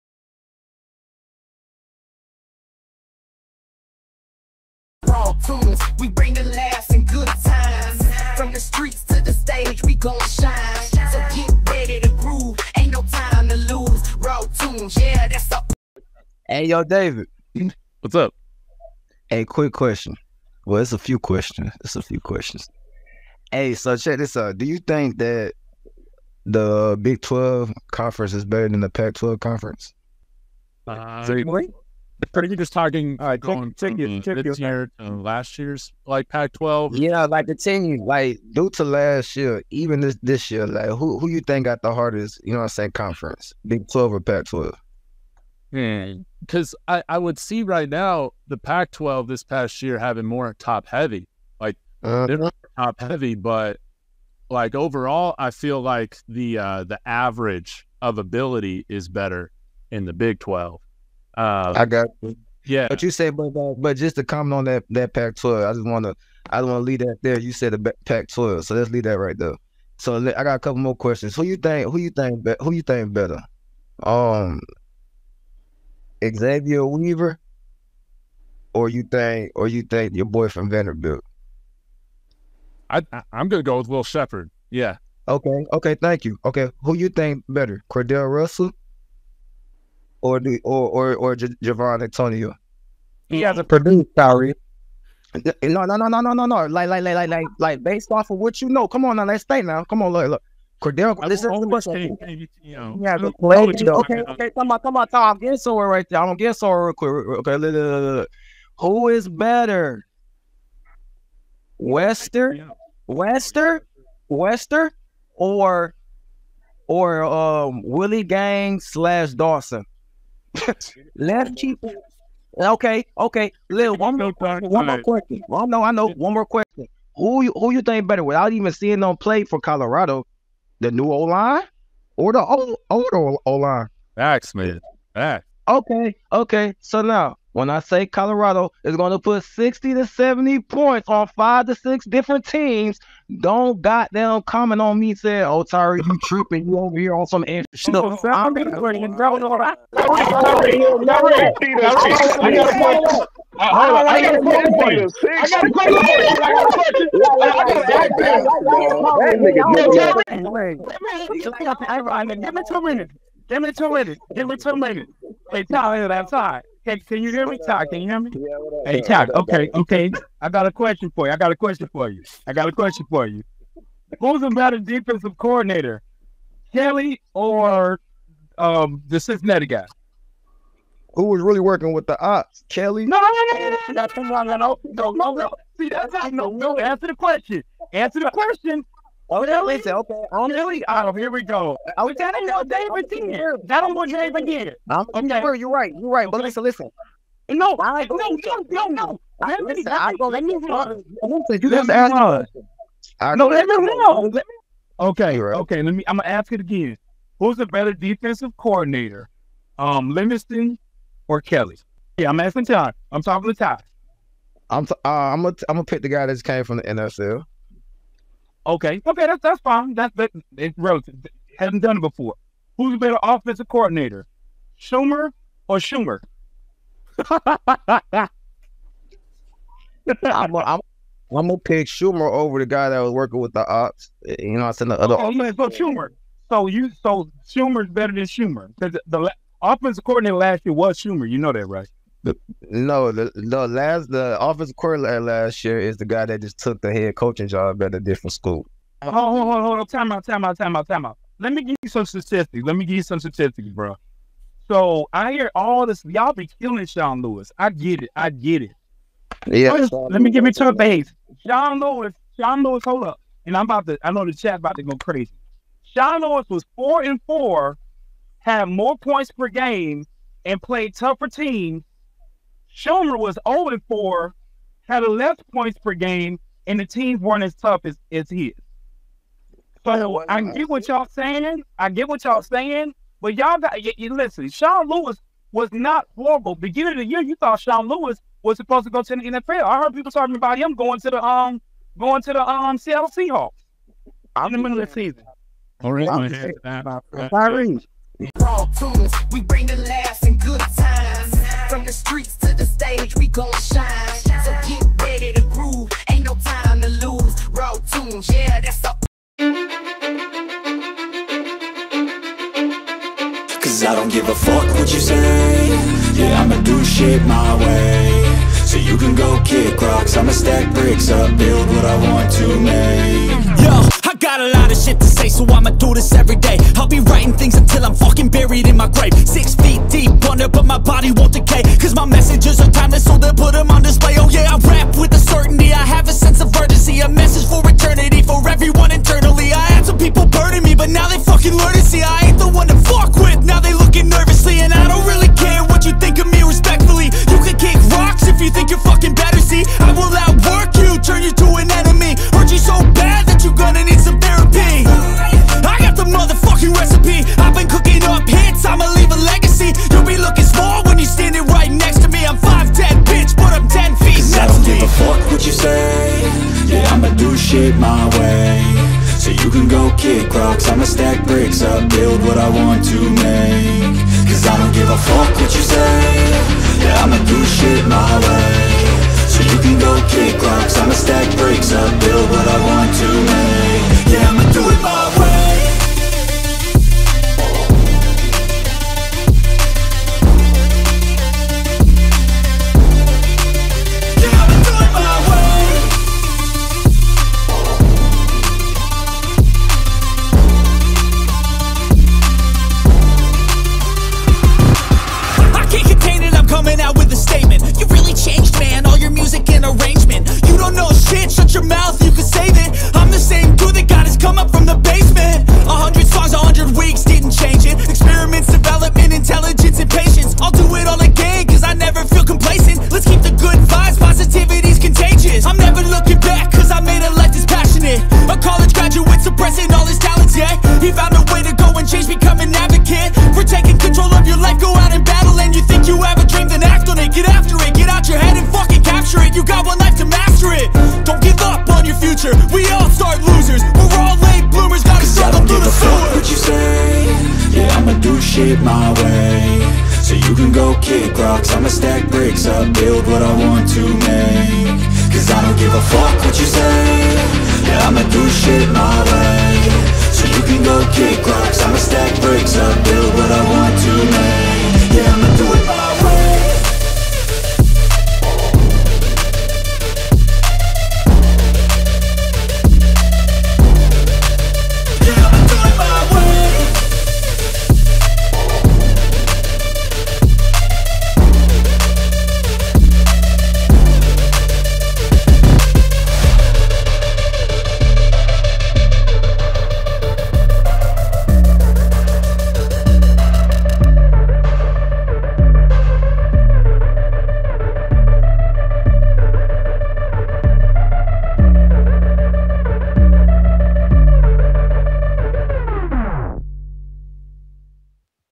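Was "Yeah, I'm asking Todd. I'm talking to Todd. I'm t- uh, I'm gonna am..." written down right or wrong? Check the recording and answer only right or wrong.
right.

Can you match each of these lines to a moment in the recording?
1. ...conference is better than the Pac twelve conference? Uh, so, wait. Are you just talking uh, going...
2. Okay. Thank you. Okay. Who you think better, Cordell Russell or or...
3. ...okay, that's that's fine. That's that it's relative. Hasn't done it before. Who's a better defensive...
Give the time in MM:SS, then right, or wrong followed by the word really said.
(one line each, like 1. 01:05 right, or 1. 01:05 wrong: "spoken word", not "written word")
1. 00:27 right
2. 01:25 right
3. 03:39 wrong: "offensive", not "defensive".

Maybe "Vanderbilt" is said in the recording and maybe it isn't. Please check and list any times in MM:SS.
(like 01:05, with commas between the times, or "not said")
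01:20.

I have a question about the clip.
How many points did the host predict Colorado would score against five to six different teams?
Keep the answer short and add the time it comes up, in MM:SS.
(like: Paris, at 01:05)
60 to 70, at 02:19.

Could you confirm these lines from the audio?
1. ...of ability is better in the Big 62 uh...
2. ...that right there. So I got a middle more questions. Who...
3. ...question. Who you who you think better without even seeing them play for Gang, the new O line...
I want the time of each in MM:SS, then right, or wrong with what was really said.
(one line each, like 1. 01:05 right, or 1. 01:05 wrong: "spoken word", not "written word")
1. 00:58 wrong: "12", not "62"
2. 01:09 wrong: "couple", not "middle"
3. 02:06 wrong: "Colorado", not "Gang".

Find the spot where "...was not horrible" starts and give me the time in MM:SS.
04:45.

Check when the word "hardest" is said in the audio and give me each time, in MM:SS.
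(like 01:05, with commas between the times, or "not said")
00:41.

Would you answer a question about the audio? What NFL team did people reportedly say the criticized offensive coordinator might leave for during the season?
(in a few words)
Seattle Seahawks.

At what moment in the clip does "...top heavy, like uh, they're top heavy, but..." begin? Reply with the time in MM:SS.
00:50.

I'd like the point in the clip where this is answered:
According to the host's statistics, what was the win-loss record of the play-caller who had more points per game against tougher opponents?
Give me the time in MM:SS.
04:26.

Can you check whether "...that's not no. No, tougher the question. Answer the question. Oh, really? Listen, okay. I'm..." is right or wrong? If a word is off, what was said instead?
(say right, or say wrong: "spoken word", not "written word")
wrong: "answer", not "tougher".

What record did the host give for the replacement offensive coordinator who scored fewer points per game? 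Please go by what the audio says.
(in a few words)
0-4.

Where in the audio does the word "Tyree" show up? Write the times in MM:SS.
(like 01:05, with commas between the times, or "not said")
02:25.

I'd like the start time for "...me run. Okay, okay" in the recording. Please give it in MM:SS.
03:23.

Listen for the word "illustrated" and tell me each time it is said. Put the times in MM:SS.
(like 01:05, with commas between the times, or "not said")
not said.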